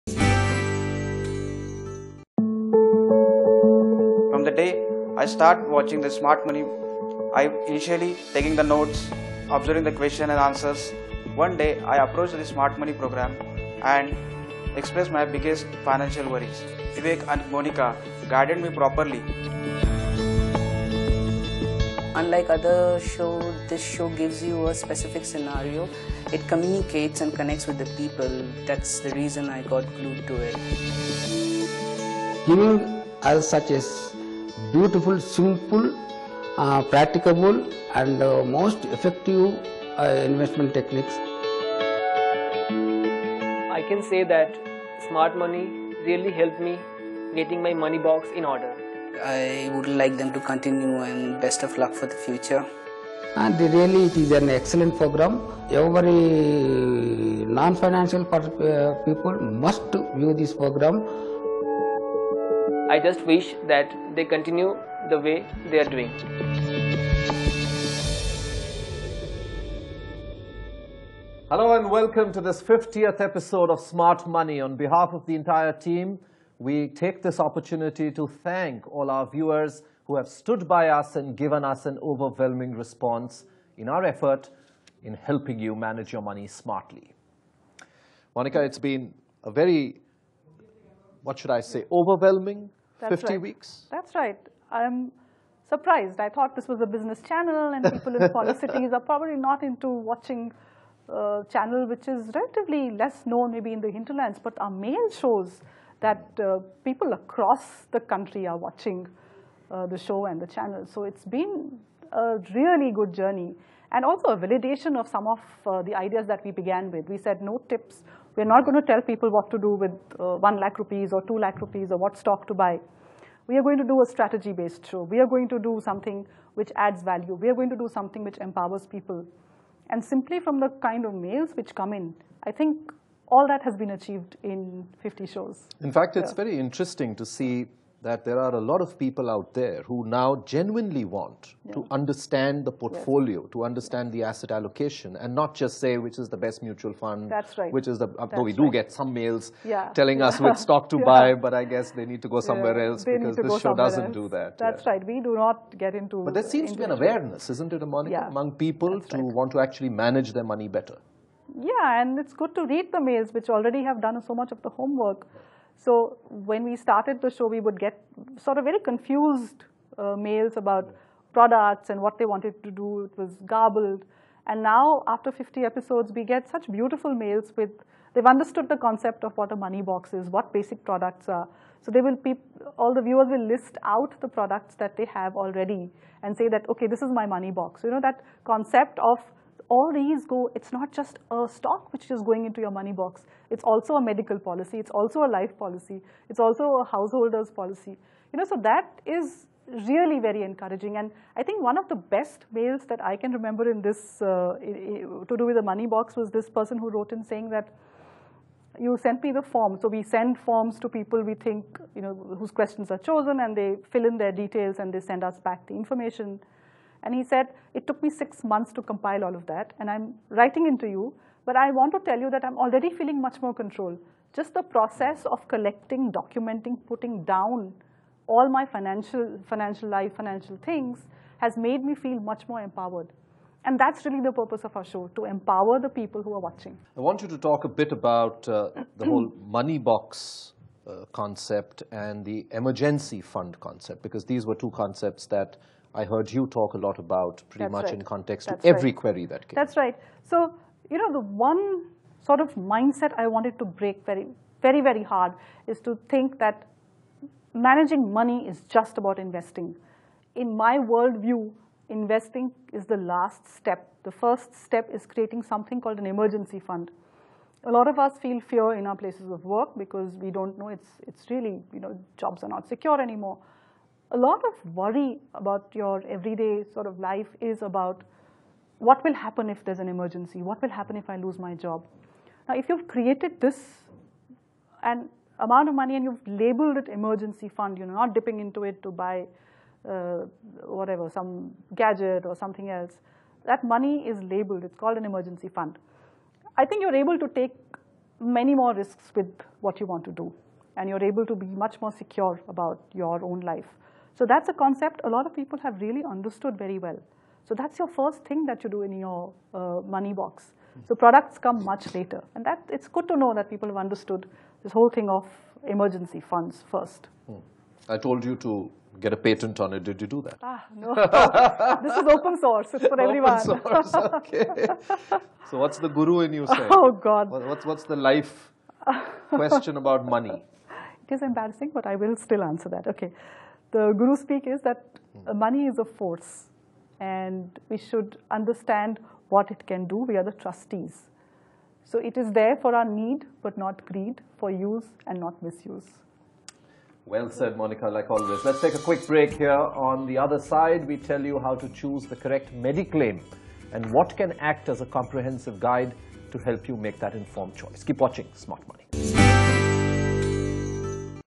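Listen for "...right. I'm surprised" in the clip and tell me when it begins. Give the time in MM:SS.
01:34.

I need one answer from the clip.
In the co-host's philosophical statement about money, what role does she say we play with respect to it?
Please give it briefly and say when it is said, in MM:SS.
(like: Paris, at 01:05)
trustees, at 05:40.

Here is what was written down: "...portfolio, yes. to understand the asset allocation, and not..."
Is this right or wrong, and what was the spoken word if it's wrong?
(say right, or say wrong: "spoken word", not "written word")
right.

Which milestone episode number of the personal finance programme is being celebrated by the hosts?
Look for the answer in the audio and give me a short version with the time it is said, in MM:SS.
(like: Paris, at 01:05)
50th, at 01:12.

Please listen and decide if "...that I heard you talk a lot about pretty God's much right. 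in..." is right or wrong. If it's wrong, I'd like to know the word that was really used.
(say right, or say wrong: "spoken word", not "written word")
wrong: "That", not "God".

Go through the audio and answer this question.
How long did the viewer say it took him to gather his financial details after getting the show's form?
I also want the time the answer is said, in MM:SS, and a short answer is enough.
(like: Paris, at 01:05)
six months, at 03:38.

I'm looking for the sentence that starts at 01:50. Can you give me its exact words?
So it's been a really good journey and also a validation of some of uh, the ideas that we began with.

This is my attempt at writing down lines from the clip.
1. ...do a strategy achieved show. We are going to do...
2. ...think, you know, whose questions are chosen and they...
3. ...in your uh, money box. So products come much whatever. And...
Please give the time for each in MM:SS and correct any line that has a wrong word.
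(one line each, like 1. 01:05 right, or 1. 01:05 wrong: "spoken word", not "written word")
1. 02:03 wrong: "based", not "achieved"
2. 03:31 right
3. 05:08 wrong: "later", not "whatever".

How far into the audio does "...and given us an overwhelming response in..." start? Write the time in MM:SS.
01:21.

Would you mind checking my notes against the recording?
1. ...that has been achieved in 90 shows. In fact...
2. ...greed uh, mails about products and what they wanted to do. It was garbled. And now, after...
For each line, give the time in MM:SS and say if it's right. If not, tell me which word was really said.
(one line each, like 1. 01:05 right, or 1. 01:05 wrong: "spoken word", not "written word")
1. 02:13 wrong: "50", not "90"
2. 02:48 wrong: "confused", not "greed".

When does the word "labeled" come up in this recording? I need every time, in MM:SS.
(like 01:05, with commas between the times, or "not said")
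04:46, 04:54.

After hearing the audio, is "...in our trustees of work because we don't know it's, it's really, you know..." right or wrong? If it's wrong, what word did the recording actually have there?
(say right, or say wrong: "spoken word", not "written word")
wrong: "places", not "trustees".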